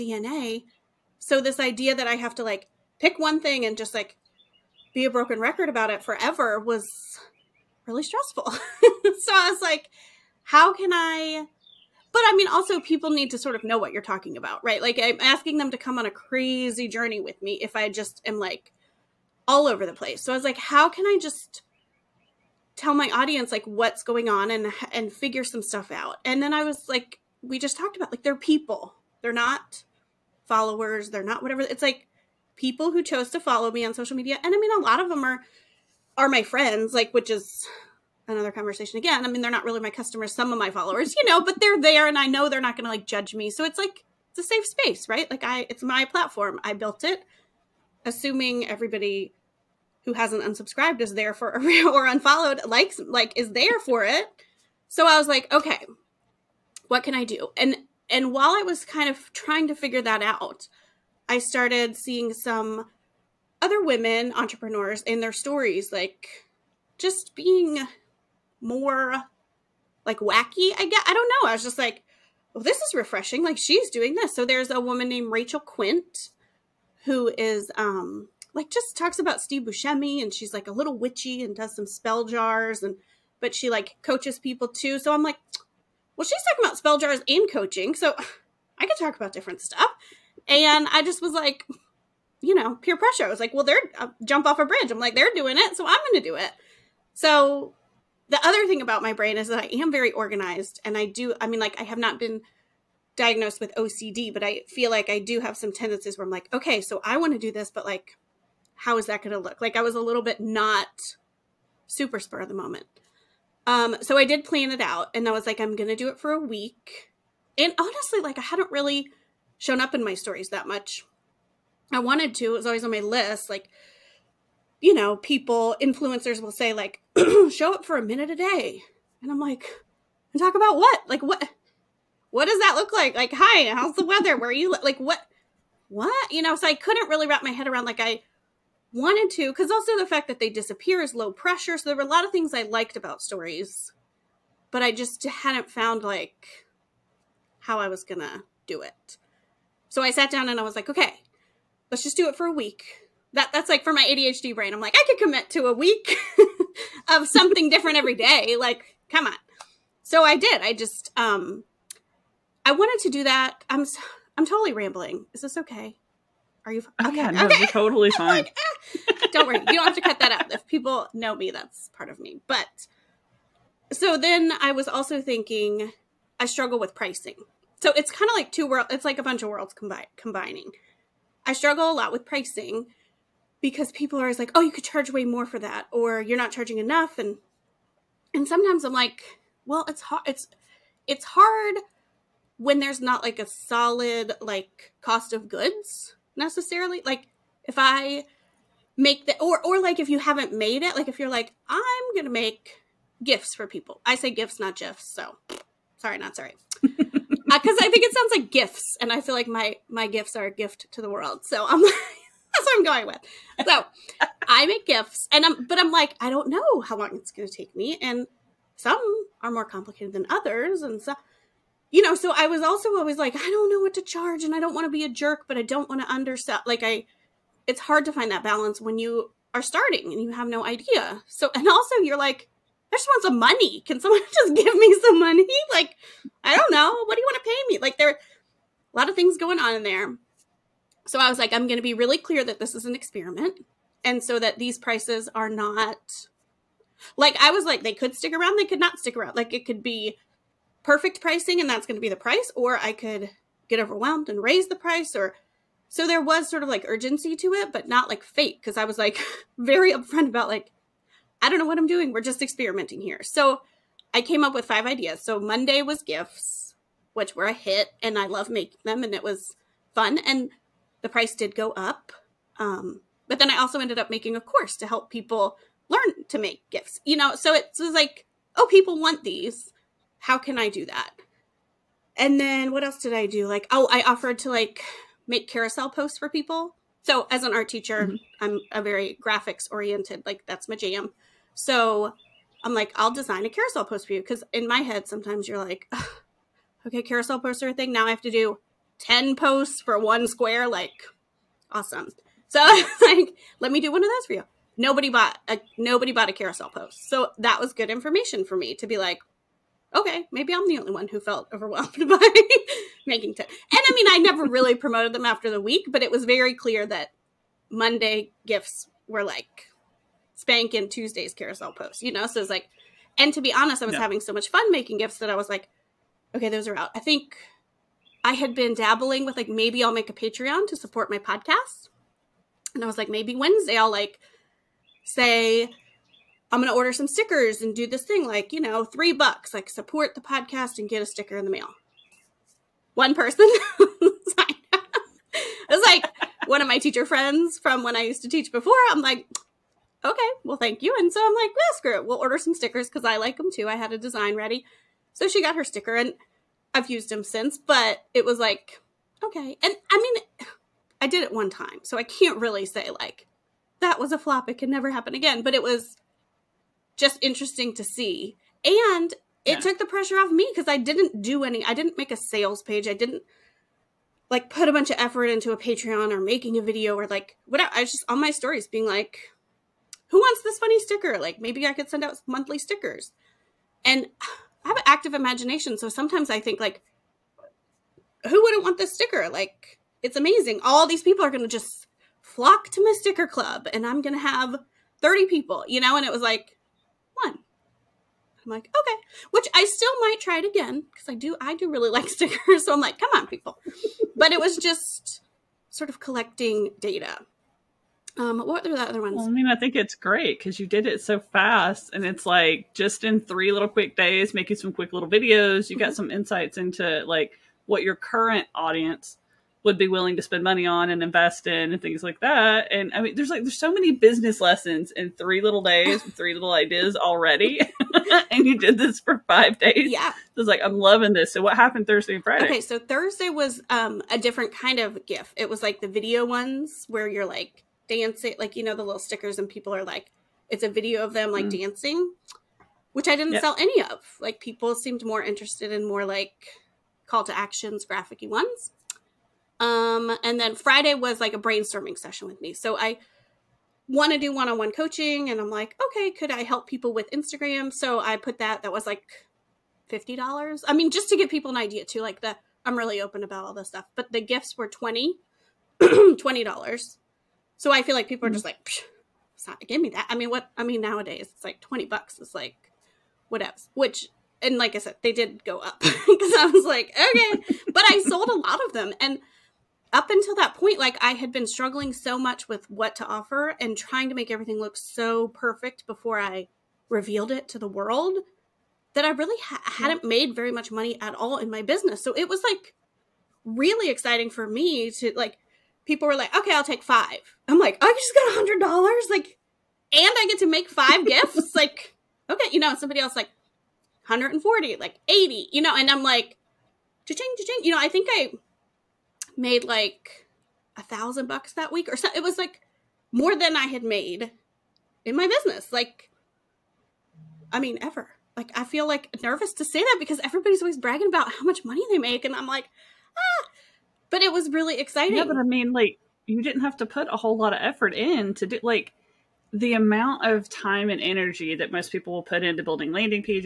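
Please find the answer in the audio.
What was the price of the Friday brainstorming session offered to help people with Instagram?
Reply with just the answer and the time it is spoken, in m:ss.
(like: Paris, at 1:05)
$50, at 7:39.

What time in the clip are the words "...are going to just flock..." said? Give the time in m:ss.
6:31.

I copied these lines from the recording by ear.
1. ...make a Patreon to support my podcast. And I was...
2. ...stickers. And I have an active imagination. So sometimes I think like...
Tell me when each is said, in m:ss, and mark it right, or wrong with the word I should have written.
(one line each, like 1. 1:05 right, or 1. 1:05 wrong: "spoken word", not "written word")
1. 5:29 right
2. 6:22 right.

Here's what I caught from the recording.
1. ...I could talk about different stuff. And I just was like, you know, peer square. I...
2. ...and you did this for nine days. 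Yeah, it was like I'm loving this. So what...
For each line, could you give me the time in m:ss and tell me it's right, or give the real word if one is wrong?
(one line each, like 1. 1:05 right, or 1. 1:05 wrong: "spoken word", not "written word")
1. 1:28 wrong: "pressure", not "square"
2. 7:08 wrong: "five", not "nine".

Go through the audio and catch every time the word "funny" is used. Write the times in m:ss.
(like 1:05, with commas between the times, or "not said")
6:20.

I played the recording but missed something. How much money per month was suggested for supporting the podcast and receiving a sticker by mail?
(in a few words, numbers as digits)
3 bucks.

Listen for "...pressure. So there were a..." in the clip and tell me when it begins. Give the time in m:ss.
2:21.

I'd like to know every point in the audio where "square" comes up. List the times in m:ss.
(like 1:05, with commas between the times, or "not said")
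5:00.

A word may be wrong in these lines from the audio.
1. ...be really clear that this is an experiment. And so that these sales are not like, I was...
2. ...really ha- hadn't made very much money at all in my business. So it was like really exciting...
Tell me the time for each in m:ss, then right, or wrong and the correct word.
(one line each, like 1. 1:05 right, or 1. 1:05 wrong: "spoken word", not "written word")
1. 4:01 wrong: "prices", not "sales"
2. 8:09 right.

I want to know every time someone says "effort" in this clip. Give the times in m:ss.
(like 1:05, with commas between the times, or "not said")
6:14, 8:47.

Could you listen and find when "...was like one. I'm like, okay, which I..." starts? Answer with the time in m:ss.
6:36.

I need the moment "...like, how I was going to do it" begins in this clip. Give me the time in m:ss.
2:26.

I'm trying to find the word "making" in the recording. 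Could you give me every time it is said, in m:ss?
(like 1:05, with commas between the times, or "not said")
4:28, 4:34, 5:13, 5:24, 6:16, 6:54.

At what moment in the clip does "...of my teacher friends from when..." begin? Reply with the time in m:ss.
5:46.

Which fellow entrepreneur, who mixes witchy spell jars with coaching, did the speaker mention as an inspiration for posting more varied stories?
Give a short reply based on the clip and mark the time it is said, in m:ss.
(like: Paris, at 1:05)
Rachel Quint, at 1:15.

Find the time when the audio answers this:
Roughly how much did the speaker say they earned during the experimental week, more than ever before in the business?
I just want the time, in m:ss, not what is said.
8:30.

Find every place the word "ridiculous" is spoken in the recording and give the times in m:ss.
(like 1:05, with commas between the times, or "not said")
not said.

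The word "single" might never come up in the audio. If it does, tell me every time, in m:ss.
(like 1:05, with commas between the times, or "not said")
not said.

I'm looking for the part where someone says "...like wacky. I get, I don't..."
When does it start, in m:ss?
1:10.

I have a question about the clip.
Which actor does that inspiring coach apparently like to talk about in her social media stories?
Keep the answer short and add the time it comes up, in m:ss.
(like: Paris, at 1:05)
Steve Buscemi, at 1:19.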